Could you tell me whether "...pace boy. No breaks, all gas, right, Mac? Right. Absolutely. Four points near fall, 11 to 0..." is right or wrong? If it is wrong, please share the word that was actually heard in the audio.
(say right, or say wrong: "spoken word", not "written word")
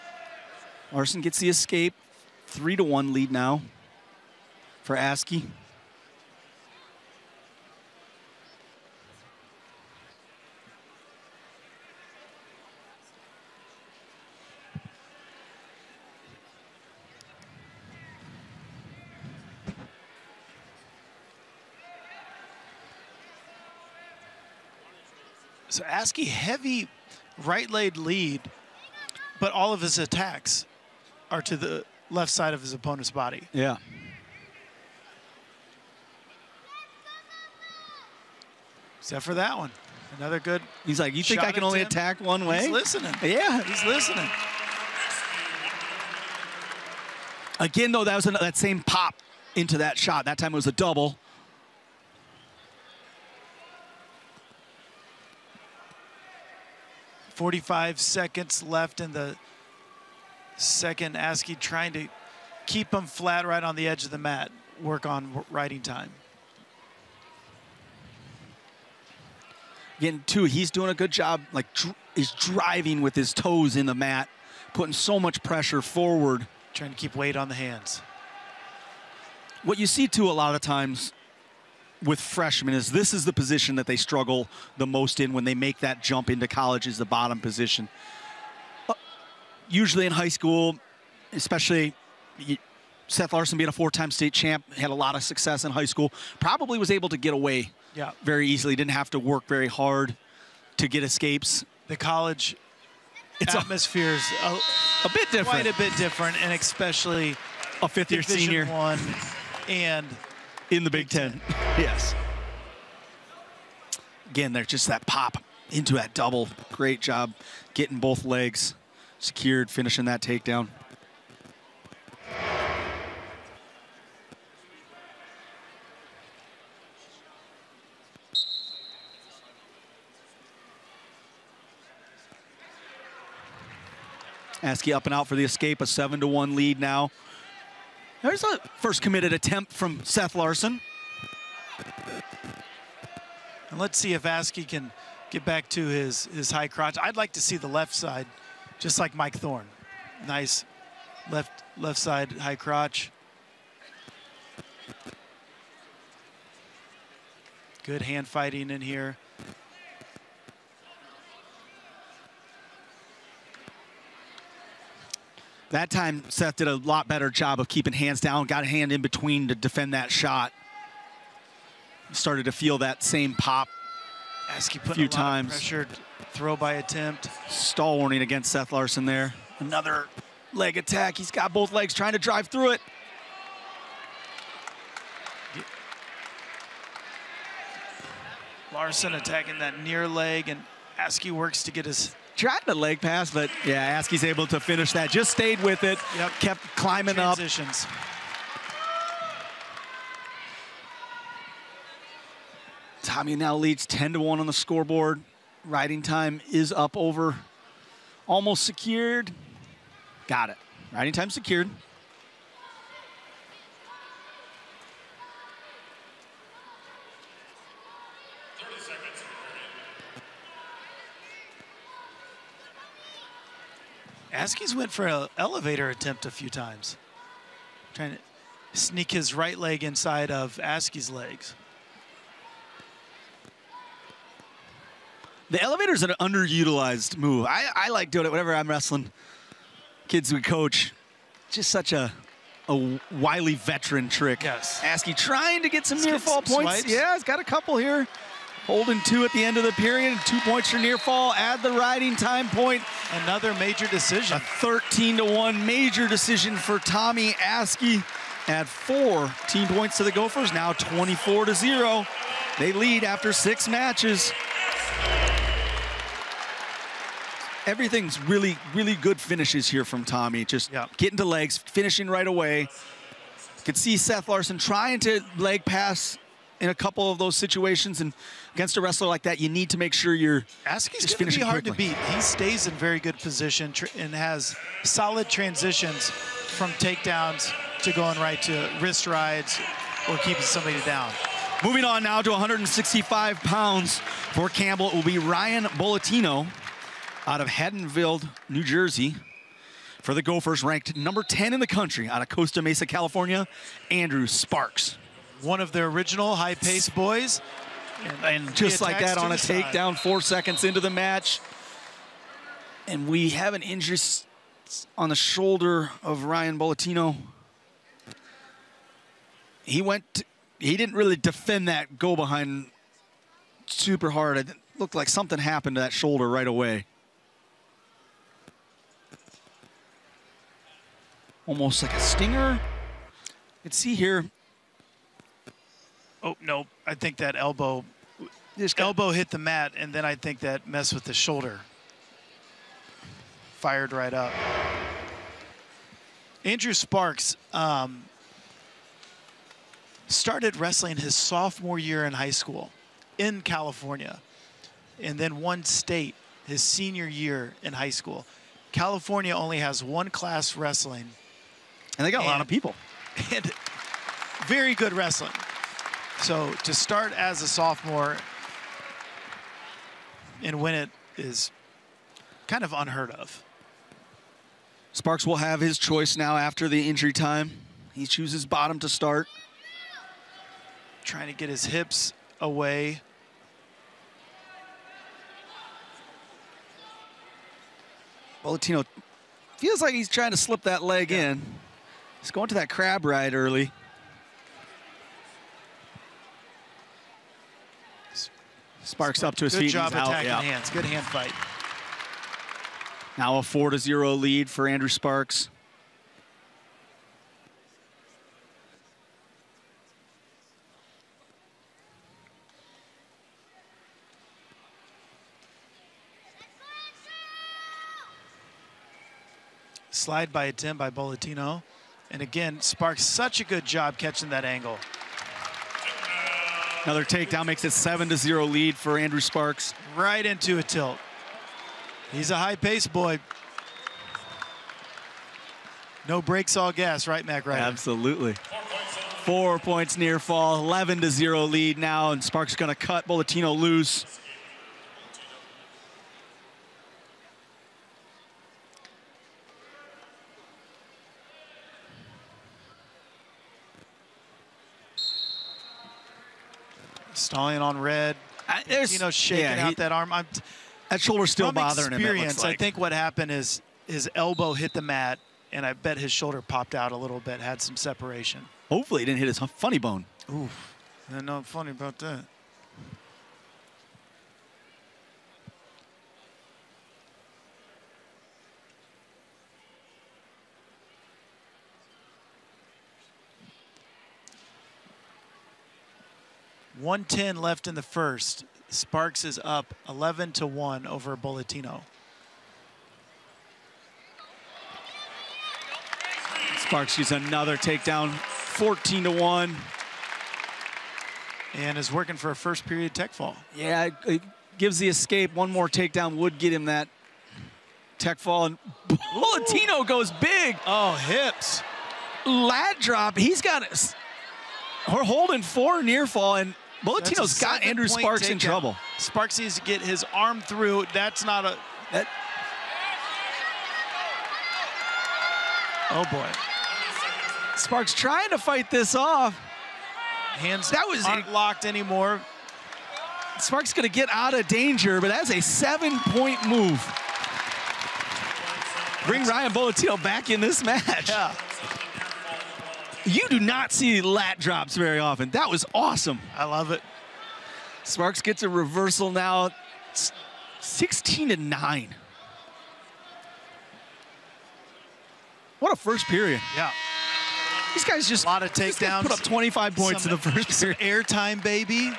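right.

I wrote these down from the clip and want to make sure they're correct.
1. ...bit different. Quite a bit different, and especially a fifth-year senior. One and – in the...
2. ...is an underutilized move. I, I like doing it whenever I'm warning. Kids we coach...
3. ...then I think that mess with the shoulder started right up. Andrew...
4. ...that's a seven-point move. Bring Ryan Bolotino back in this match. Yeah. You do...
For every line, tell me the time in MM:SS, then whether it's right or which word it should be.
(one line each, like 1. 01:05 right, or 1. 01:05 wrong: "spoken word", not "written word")
1. 01:45 right
2. 03:55 wrong: "wrestling", not "warning"
3. 05:39 wrong: "fired", not "started"
4. 08:55 right.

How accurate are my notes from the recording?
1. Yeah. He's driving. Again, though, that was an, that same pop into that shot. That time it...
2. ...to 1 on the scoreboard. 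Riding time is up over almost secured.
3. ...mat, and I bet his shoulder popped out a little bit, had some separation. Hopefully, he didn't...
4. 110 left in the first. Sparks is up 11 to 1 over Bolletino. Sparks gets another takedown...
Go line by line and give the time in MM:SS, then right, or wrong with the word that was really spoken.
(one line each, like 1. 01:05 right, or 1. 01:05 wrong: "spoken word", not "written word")
1. 00:43 wrong: "listening", not "driving"
2. 03:24 right
3. 07:44 right
4. 08:06 right.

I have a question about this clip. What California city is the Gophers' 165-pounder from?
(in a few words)
Costa Mesa.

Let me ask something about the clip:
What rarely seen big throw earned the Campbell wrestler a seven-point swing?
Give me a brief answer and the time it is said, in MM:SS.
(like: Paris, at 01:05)
Lat drop, at 08:32.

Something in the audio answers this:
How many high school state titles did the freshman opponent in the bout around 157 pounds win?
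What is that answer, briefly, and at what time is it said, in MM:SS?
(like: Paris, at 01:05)
4, at 01:33.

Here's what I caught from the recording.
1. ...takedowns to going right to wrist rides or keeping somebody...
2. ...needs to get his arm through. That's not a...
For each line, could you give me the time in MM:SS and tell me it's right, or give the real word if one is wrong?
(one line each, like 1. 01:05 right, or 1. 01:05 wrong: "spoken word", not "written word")
1. 04:46 right
2. 08:39 right.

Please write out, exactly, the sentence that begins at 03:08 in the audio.
Larson attacking that near leg, and Askey works to get his tried the leg pass, but yeah, Askey's able to finish that.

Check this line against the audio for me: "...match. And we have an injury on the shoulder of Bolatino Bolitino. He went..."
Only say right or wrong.
wrong.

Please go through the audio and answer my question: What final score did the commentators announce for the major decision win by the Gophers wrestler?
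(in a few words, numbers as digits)
13 to 1.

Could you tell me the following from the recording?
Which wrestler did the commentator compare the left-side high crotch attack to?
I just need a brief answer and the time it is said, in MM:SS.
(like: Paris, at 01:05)
Mike Thorne, at 02:29.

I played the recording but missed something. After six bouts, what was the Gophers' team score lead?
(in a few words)
24 to 0.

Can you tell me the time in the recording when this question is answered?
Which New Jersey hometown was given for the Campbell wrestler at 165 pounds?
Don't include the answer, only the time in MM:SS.
04:57.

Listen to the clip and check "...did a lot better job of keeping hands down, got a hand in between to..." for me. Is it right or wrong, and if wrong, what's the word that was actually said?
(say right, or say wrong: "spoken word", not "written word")
right.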